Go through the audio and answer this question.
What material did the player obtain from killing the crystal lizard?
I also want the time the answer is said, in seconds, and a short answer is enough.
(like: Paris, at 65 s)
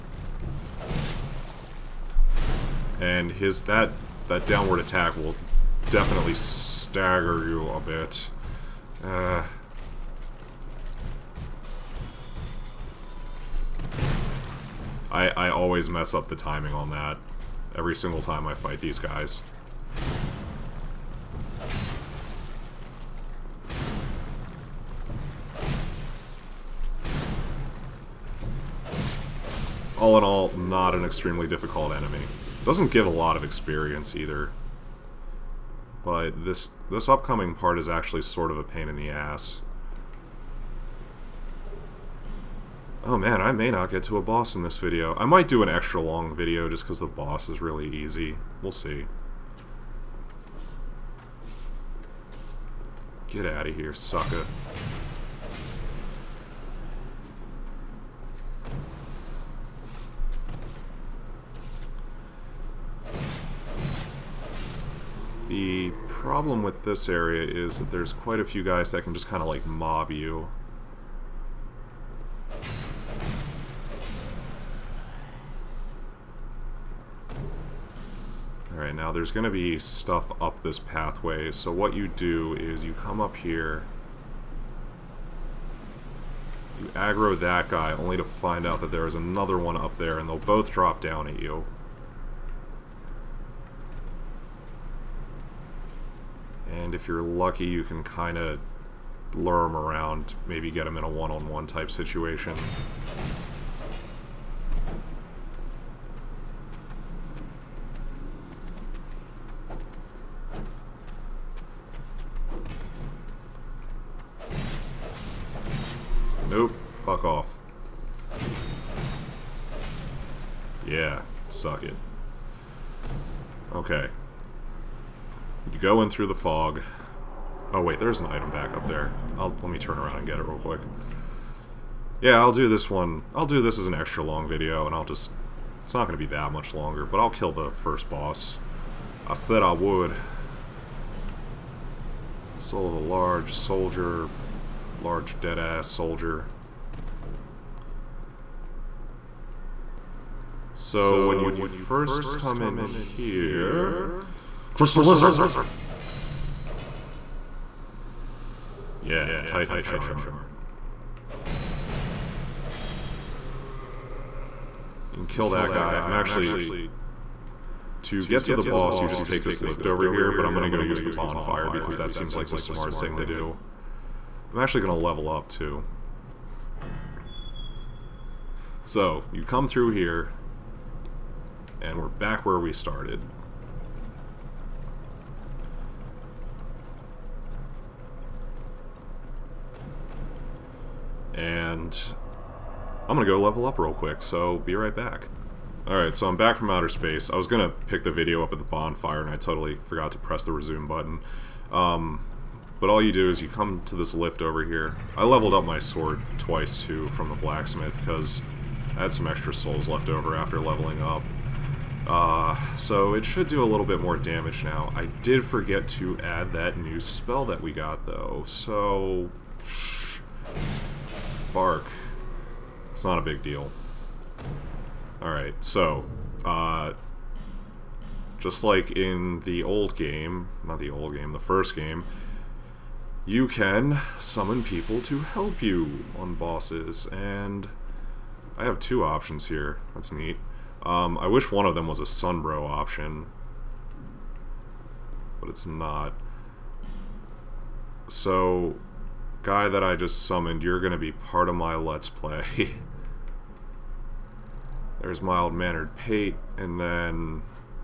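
Titanite Shard, at 159 s.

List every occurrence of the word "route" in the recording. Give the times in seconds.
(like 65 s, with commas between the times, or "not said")
not said.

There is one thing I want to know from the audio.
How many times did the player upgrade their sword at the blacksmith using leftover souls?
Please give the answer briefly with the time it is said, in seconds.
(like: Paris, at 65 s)
2, at 206 s.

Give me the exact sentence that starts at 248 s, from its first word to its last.
So, guy that I just summoned, you're going to be part of my Let's Play.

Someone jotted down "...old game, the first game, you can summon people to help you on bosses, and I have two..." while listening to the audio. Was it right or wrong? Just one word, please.
right.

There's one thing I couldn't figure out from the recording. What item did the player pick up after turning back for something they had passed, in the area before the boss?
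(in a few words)
Soul of a Large Soldier.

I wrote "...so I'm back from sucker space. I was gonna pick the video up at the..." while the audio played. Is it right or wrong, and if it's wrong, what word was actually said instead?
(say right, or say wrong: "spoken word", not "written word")
wrong: "outer", not "sucker".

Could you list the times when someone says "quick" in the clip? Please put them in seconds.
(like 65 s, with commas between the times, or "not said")
130 s, 193 s.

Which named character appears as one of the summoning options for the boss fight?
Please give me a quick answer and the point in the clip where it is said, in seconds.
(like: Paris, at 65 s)
Mild Mannered Pate, at 255 s.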